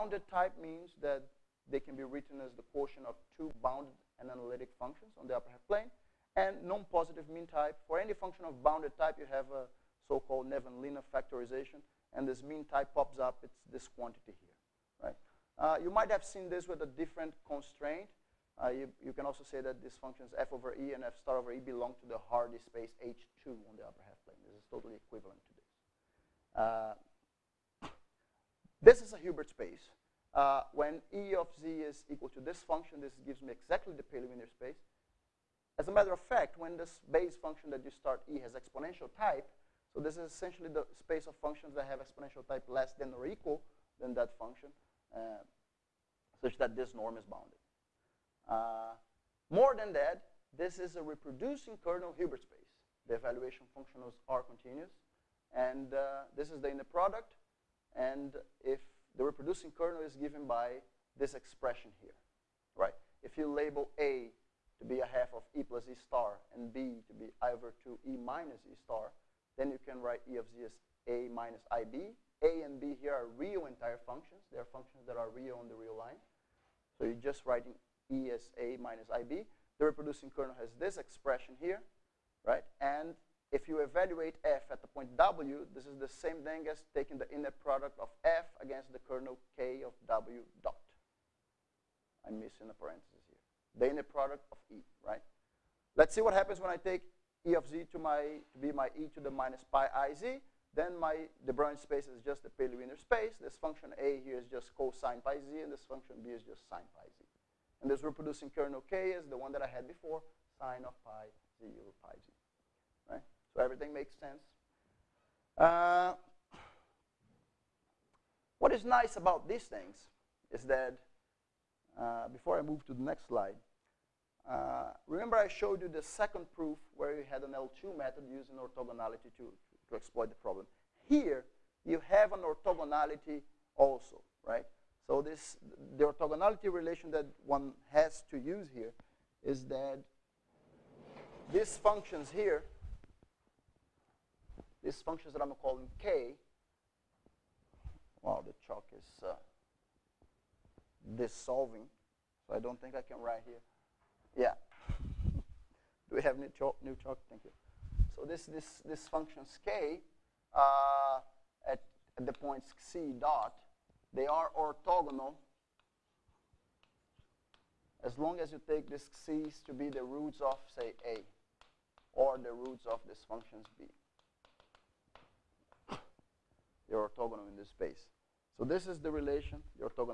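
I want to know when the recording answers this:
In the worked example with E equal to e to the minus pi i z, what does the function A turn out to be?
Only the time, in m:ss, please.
1:44.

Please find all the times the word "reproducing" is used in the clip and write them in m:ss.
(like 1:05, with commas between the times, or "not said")
0:51, 0:59, 1:19, 1:48.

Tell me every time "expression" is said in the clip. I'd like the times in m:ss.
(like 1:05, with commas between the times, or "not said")
1:01, 1:20.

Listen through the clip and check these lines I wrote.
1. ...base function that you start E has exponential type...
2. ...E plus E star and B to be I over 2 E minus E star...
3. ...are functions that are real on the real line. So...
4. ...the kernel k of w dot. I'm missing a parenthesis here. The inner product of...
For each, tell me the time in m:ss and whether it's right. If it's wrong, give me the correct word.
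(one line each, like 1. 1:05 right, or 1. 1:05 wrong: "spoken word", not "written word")
1. 0:37 right
2. 1:05 right
3. 1:14 right
4. 1:28 right.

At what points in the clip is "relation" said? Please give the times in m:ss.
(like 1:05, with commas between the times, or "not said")
2:16, 2:59.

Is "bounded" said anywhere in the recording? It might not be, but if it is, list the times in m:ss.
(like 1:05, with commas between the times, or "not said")
0:03, 0:08, 0:47.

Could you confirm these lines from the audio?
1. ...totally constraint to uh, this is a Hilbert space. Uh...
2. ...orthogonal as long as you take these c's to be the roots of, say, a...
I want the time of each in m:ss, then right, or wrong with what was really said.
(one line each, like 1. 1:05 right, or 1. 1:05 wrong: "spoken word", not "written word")
1. 0:24 wrong: "equivalent", not "constraint"
2. 2:44 right.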